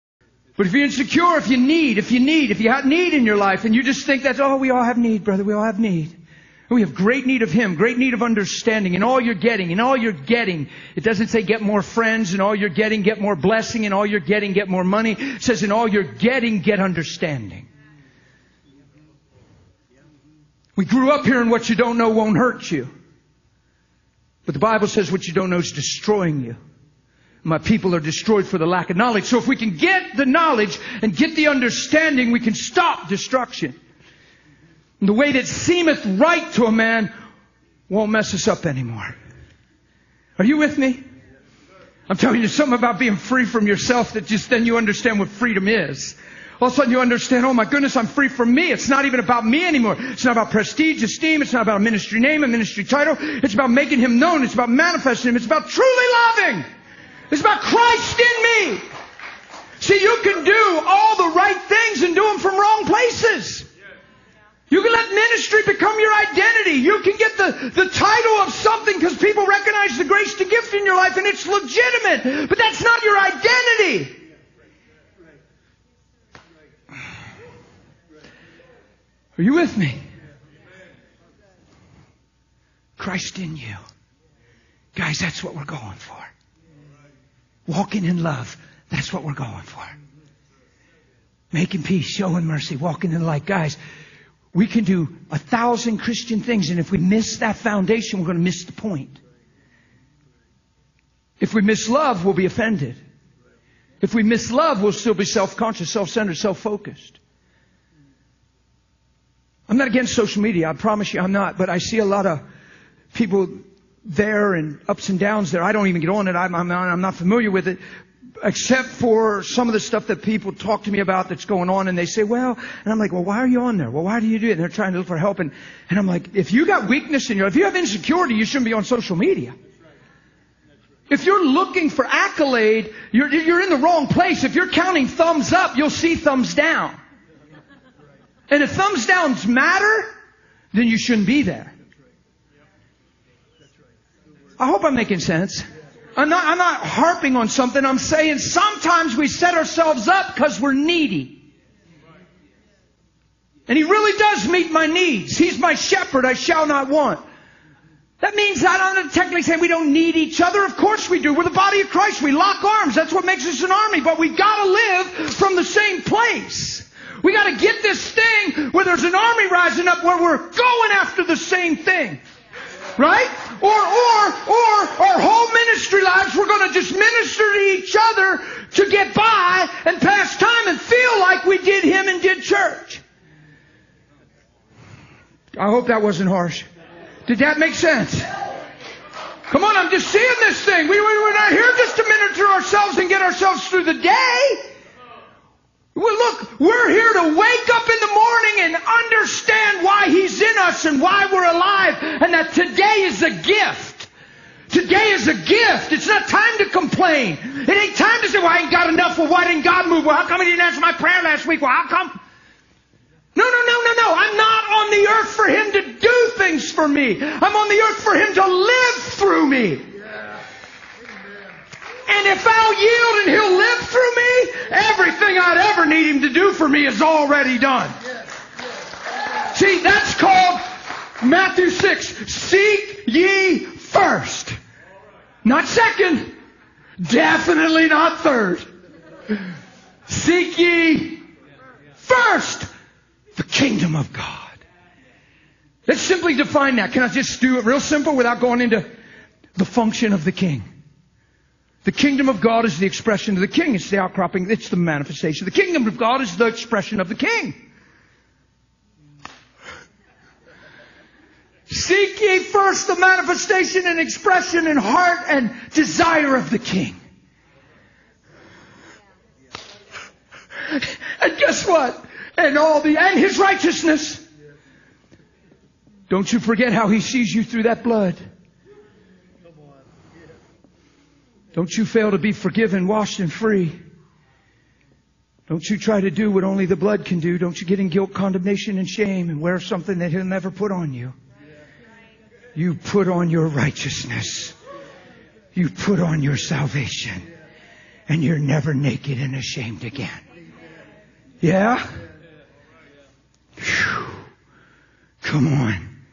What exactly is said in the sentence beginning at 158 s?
That means I don't technically say we don't need each other.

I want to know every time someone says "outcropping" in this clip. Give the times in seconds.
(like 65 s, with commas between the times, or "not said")
253 s.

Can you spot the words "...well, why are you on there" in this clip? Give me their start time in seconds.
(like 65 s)
123 s.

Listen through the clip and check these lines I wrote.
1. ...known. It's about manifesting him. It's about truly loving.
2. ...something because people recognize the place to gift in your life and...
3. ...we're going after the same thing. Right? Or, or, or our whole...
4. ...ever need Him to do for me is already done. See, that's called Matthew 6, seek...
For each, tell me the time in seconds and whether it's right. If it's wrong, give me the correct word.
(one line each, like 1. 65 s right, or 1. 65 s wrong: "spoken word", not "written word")
1. 54 s right
2. 68 s wrong: "grace", not "place"
3. 170 s right
4. 225 s right.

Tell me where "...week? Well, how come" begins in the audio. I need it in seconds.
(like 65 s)
211 s.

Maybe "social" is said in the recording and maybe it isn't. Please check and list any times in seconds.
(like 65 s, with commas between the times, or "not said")
110 s, 128 s.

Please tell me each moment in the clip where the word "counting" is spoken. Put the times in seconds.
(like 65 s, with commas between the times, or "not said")
134 s.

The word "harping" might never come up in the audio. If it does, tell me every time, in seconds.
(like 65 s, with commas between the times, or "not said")
146 s.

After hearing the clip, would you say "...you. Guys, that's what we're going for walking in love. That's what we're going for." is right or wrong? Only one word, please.
right.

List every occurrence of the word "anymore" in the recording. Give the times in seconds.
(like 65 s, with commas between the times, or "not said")
38 s, 49 s.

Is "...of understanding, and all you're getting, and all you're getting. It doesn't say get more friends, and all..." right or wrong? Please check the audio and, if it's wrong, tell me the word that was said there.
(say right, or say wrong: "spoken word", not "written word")
right.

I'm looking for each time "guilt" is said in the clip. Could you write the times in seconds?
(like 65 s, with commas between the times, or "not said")
287 s.